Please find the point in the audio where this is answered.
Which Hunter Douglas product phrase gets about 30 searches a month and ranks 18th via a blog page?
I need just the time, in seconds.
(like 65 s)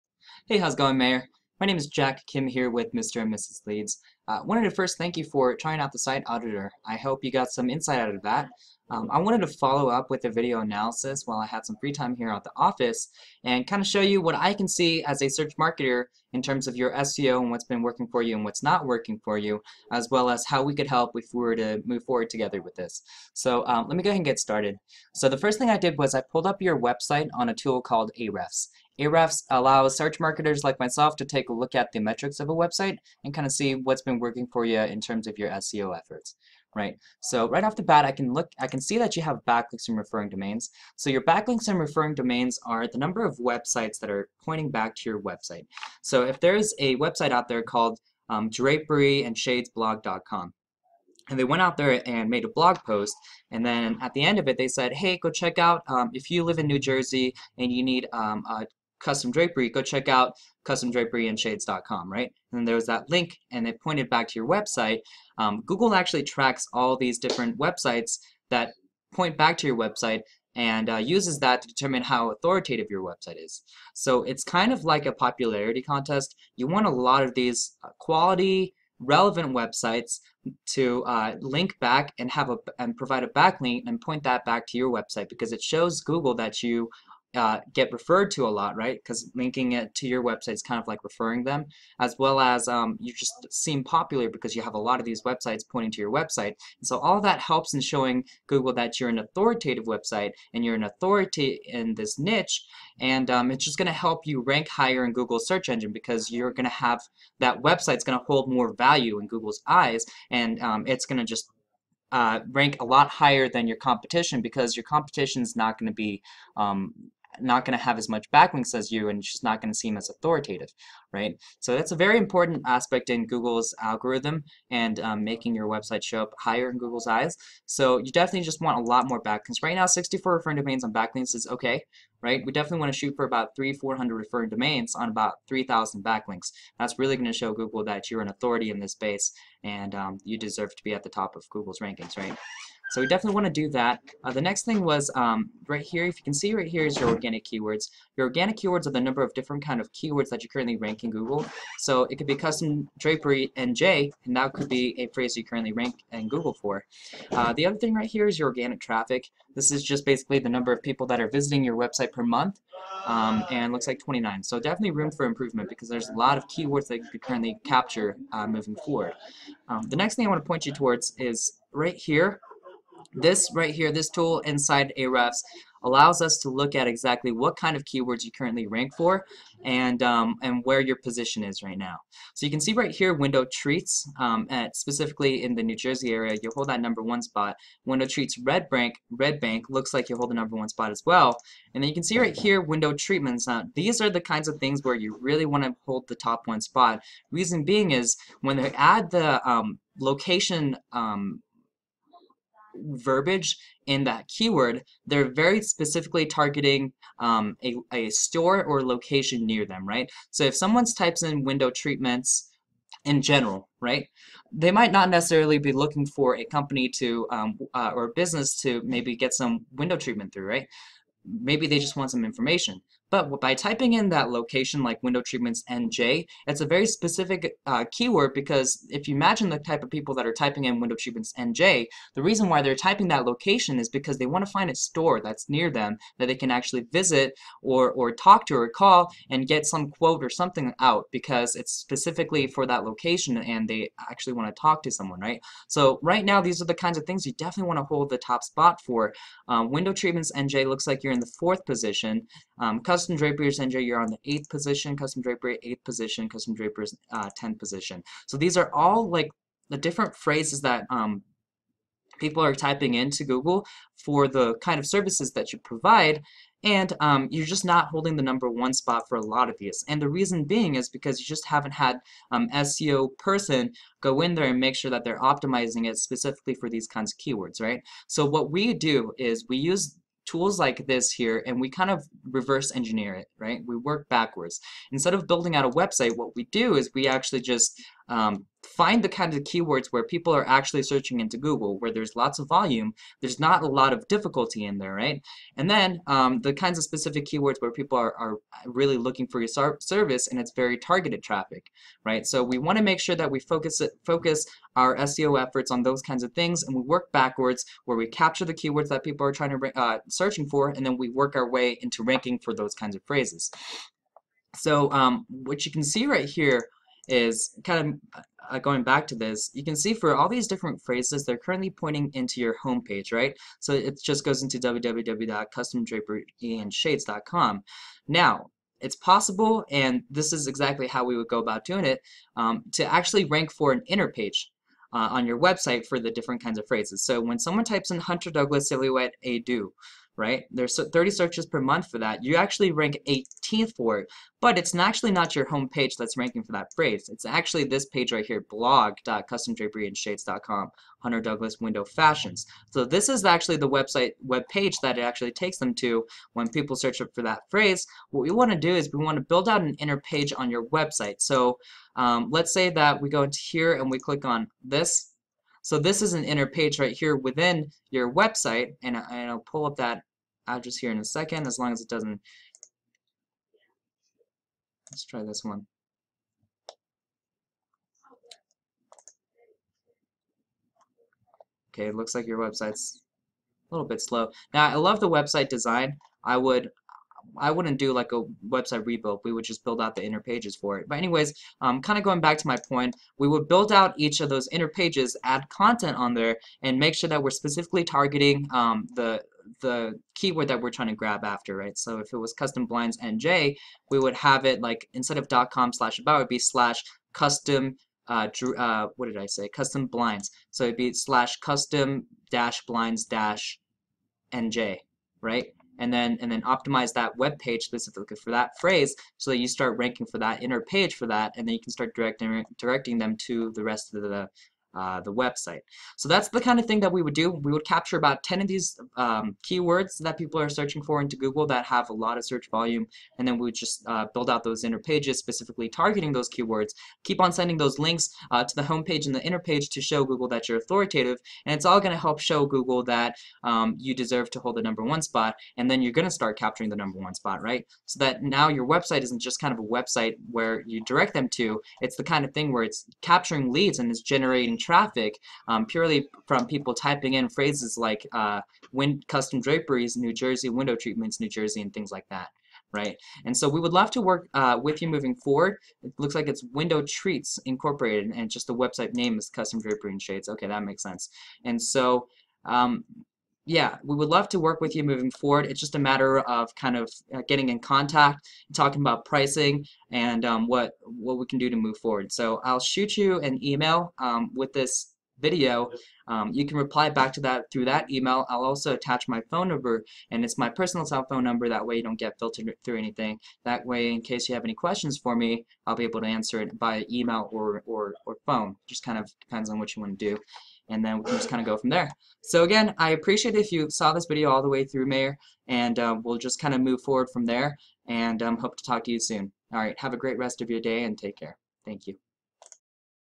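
338 s.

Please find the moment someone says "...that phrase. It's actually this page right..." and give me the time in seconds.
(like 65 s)
346 s.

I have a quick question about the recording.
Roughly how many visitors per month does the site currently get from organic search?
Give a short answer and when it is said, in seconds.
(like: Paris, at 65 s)
29, at 163 s.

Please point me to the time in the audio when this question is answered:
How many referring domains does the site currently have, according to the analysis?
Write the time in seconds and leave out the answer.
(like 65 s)
129 s.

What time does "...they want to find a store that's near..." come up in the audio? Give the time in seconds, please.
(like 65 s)
234 s.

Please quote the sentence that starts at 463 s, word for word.
And so we would love to work uh, with you moving forward.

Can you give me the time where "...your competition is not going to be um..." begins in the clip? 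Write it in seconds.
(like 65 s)
114 s.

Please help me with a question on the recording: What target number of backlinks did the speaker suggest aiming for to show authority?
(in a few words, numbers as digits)
3,000.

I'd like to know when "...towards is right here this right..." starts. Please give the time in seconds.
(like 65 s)
170 s.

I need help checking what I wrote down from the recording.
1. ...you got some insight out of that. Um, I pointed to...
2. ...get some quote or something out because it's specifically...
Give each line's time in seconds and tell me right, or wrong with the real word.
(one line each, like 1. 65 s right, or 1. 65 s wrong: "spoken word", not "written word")
1. 7 s wrong: "wanted", not "pointed"
2. 239 s right.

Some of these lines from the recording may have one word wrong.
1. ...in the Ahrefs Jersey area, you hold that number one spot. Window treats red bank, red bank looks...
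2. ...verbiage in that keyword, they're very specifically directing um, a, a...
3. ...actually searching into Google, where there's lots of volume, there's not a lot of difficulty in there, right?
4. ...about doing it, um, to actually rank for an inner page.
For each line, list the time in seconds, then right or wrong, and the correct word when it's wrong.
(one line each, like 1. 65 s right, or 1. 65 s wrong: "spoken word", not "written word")
1. 185 s wrong: "New", not "Ahrefs"
2. 202 s wrong: "targeting", not "directing"
3. 290 s right
4. 331 s right.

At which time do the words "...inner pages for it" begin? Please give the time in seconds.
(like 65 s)
390 s.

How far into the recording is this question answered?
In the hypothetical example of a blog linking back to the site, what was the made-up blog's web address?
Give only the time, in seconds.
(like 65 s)
48 s.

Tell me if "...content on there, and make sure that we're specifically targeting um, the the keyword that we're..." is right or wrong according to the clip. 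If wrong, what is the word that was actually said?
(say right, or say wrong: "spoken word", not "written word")
right.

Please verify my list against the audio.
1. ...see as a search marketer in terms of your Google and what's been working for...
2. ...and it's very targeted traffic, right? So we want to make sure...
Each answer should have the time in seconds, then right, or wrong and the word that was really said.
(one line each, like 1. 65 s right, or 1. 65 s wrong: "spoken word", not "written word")
1. 14 s wrong: "SEO", not "Google"
2. 300 s right.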